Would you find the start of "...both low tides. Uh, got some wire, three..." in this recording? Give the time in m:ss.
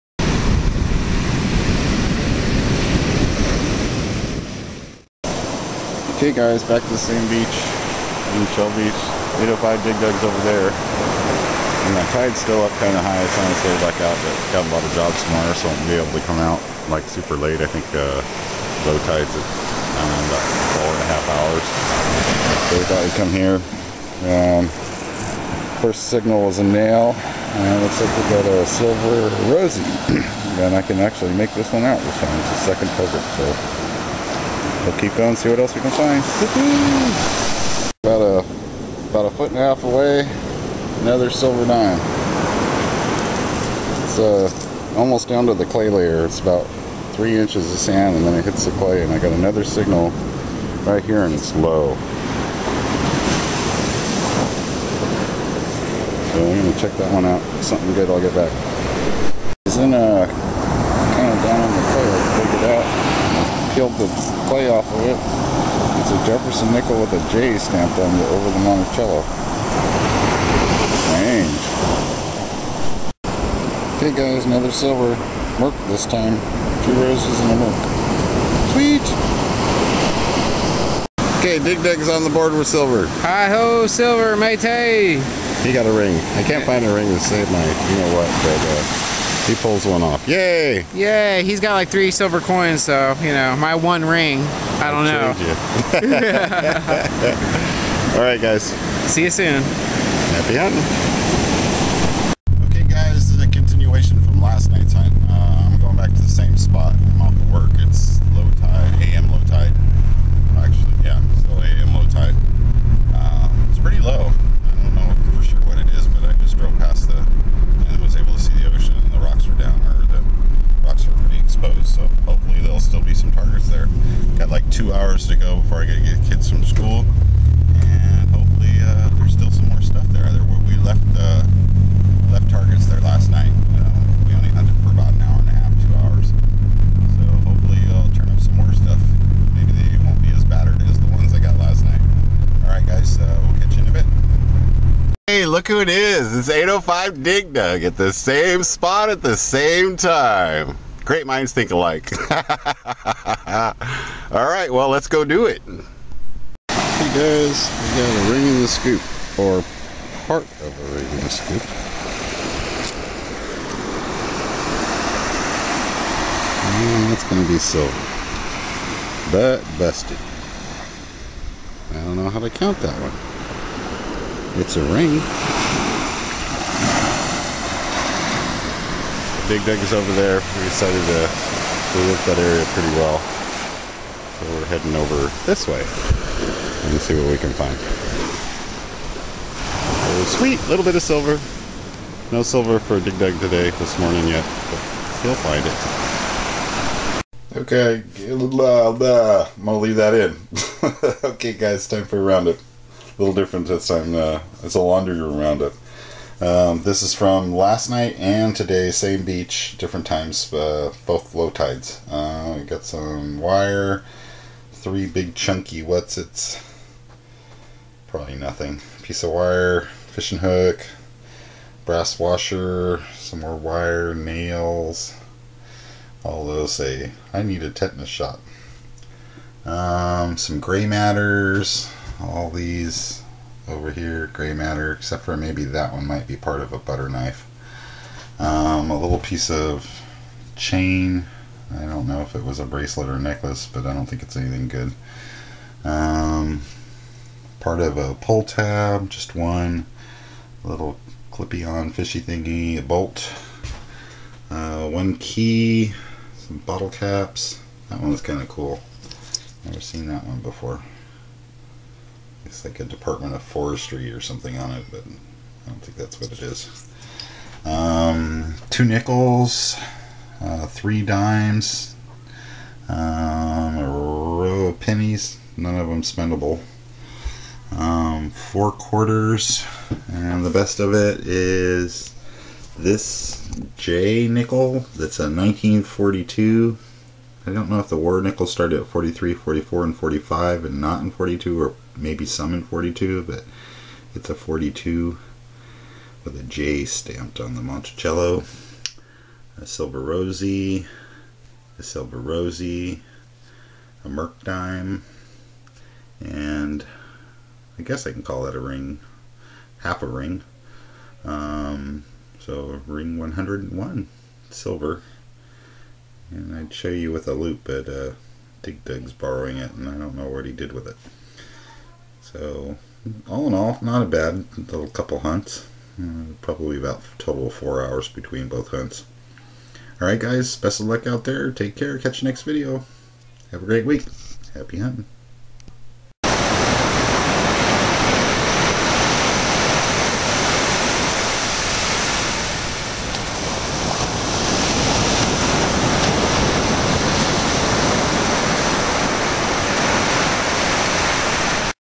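3:31.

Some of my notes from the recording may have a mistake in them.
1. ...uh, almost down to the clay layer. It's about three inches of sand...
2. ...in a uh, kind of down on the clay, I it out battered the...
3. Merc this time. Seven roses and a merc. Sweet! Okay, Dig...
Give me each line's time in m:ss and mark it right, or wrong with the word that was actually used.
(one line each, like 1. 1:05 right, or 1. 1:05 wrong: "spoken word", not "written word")
1. 0:44 right
2. 0:59 wrong: "killed", not "battered"
3. 1:15 wrong: "Two", not "Seven".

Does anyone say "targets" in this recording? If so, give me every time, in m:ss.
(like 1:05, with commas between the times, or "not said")
2:03, 2:12.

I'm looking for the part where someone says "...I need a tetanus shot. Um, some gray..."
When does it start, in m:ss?
3:47.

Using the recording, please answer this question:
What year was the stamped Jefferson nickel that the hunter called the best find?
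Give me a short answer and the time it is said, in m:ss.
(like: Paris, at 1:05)
1942, at 4:45.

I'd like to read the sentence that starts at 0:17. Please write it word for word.
I think uh, low tide's at um, about four and a half hours.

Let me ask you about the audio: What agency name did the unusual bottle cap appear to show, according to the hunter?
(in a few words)
Department of Forestry.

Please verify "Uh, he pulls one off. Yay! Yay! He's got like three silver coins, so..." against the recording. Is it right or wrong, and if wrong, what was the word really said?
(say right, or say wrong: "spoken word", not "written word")
right.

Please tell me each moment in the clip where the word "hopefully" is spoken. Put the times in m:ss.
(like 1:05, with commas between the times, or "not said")
2:02, 2:08, 2:17.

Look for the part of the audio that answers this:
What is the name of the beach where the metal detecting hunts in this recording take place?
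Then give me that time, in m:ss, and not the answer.
0:08.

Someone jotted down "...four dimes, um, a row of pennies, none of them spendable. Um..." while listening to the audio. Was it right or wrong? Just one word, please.
wrong.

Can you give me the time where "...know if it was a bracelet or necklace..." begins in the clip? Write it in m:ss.
4:02.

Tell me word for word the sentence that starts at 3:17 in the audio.
Okay, I'm gonna leave that in.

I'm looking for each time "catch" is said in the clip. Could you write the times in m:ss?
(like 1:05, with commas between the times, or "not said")
2:23, 5:31.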